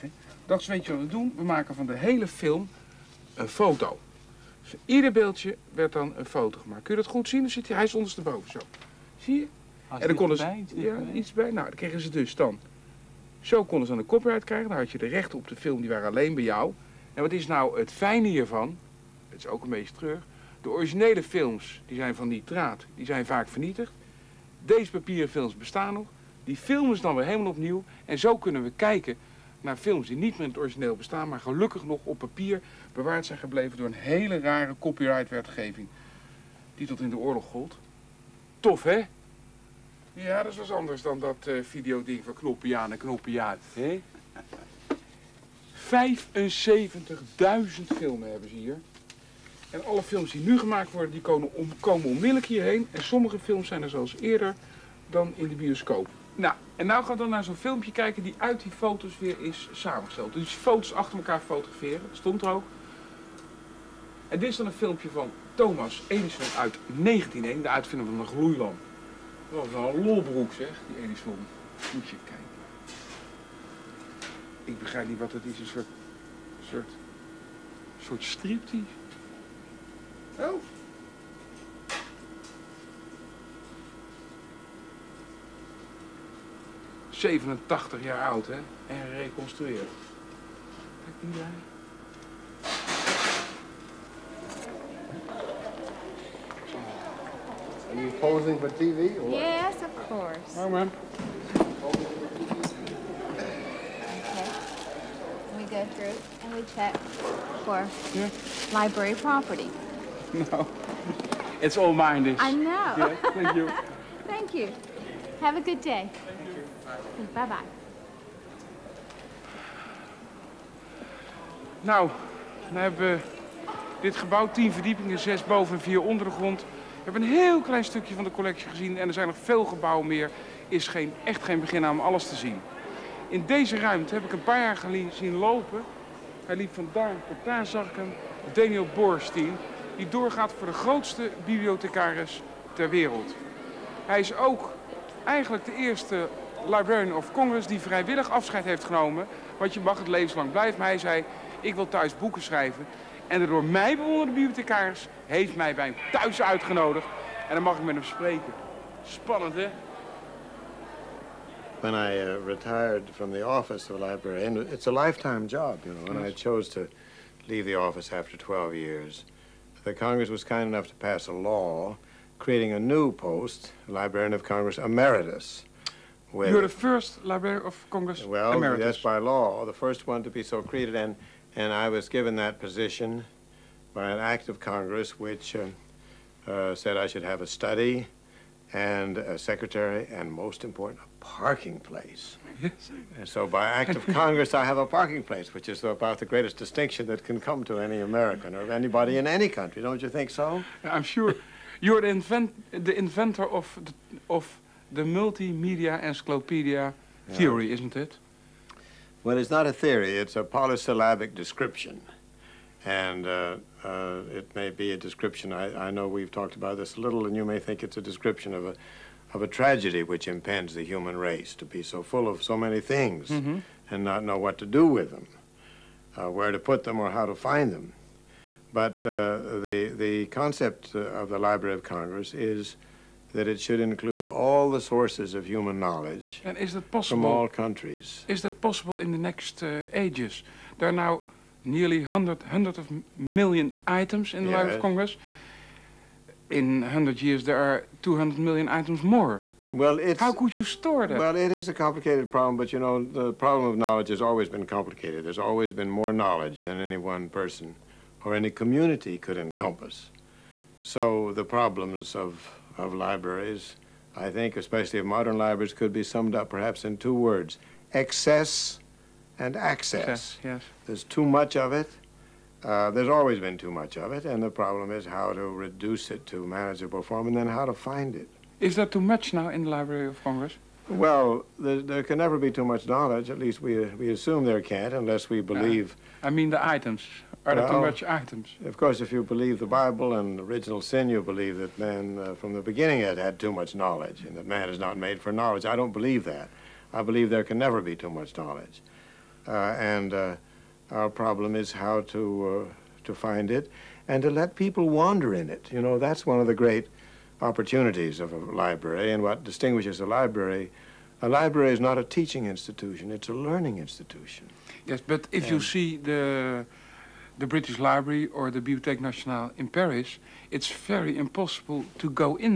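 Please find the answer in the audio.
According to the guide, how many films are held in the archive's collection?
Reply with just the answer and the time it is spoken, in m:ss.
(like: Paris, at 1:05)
75,000, at 0:47.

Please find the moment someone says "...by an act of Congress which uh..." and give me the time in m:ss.
3:03.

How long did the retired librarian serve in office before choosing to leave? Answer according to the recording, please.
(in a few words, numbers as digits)
12 years.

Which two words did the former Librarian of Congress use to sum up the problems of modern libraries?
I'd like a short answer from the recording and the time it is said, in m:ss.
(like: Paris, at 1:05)
excess and access, at 4:27.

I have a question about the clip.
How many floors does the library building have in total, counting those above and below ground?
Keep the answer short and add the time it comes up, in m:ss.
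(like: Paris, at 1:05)
10, at 2:04.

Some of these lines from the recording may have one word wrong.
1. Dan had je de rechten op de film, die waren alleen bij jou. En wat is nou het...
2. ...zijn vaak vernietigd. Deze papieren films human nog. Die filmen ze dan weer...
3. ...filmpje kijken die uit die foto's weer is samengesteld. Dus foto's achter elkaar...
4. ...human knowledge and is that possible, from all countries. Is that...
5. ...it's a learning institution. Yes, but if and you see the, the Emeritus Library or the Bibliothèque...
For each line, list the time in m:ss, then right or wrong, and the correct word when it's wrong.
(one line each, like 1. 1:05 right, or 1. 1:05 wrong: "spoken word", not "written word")
1. 0:14 right
2. 0:23 wrong: "bestaan", not "human"
3. 0:57 right
4. 3:55 right
5. 5:13 wrong: "British", not "Emeritus".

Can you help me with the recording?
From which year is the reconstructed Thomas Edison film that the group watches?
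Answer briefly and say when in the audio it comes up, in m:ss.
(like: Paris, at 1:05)
1901, at 1:06.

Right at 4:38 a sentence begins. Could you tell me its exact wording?
Is there too much now in the Library of Congress?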